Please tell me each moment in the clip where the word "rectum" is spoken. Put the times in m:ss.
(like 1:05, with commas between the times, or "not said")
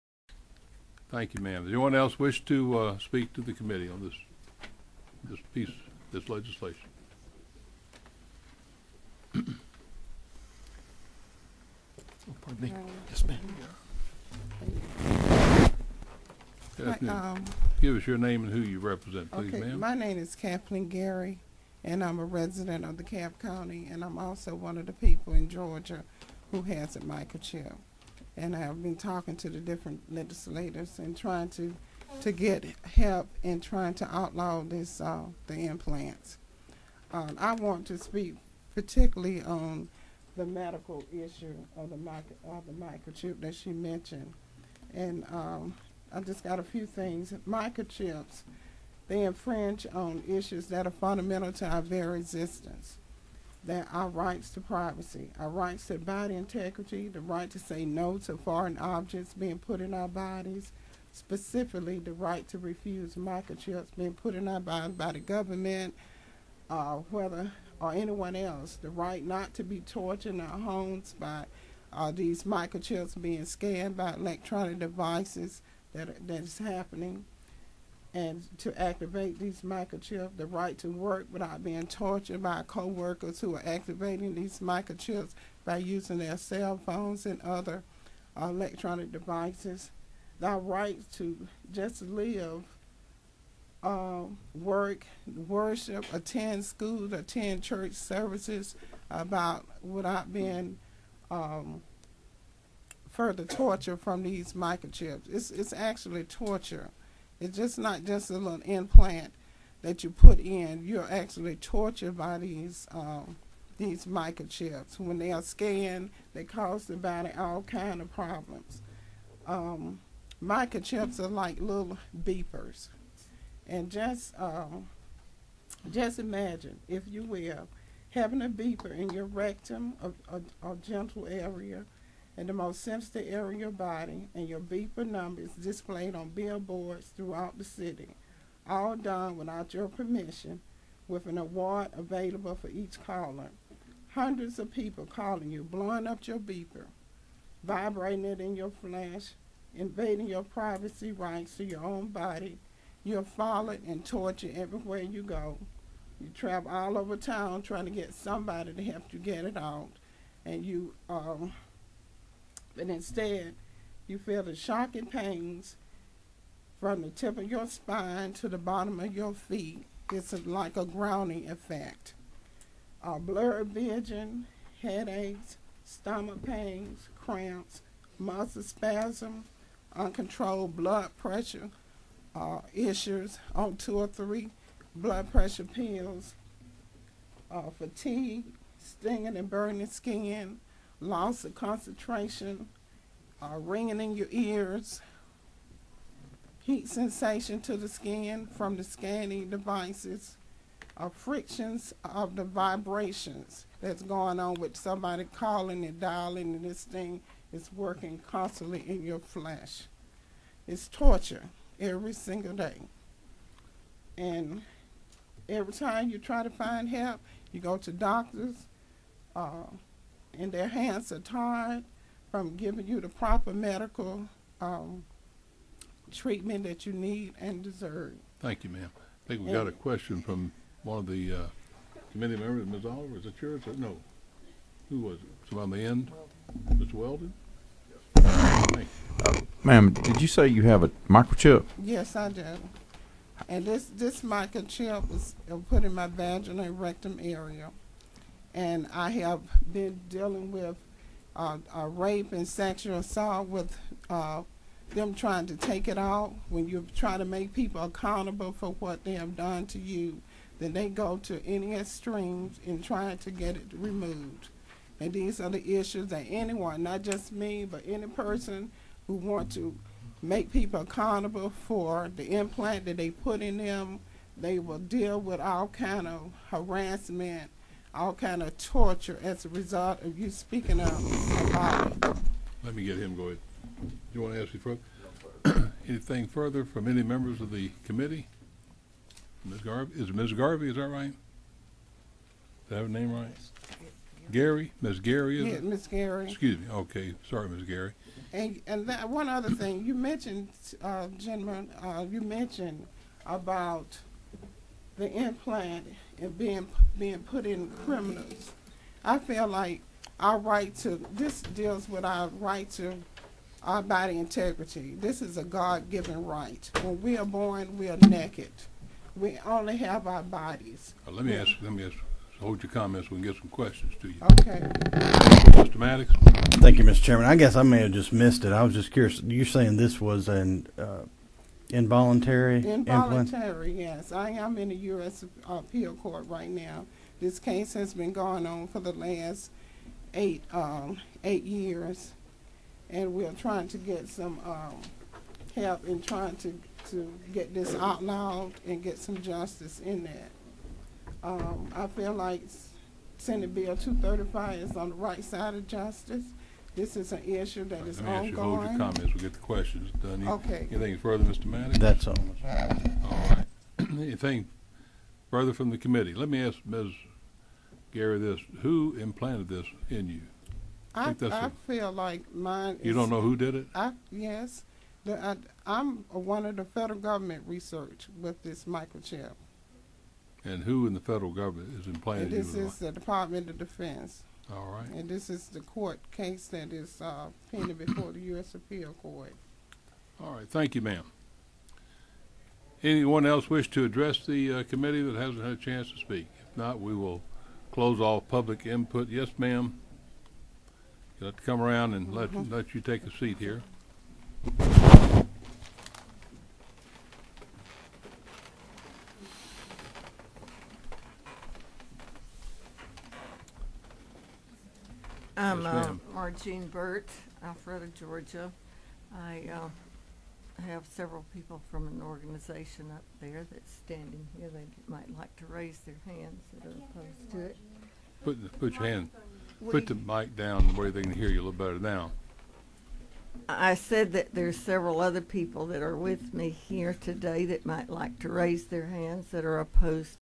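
2:09, 4:06.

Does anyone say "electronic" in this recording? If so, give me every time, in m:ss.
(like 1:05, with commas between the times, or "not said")
1:14, 1:28.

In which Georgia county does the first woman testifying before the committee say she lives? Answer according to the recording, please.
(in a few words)
Cobb County.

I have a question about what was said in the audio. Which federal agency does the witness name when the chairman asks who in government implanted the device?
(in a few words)
Department of Defense.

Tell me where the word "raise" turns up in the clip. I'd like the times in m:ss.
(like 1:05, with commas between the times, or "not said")
7:05, 7:18.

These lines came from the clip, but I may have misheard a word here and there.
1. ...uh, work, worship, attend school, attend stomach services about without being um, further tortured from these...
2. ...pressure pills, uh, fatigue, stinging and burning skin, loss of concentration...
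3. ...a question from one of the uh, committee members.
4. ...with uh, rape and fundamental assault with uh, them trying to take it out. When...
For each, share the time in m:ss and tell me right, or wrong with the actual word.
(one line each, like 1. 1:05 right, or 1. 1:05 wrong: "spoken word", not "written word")
1. 1:33 wrong: "church", not "stomach"
2. 3:05 right
3. 3:49 right
4. 4:10 wrong: "sexual", not "fundamental".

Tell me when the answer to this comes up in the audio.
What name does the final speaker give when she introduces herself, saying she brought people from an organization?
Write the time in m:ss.
6:56.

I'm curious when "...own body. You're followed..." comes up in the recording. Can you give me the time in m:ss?
2:31.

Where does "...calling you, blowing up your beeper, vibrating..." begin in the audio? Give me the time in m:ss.
2:25.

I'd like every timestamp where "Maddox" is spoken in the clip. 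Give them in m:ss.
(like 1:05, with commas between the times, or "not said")
5:25, 6:01.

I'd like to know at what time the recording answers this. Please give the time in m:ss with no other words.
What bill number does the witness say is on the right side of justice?
5:53.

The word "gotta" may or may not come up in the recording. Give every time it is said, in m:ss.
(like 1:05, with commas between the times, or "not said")
not said.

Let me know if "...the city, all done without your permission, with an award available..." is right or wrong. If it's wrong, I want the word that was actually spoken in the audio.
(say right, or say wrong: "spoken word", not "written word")
right.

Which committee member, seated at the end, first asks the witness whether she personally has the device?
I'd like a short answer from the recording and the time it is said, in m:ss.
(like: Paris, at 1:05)
Mr. Weldon, at 3:56.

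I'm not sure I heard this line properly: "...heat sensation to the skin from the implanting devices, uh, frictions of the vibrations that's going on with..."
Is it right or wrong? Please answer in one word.
wrong.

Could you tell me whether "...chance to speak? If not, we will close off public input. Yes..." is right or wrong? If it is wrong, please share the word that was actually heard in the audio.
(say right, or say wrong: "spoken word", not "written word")
right.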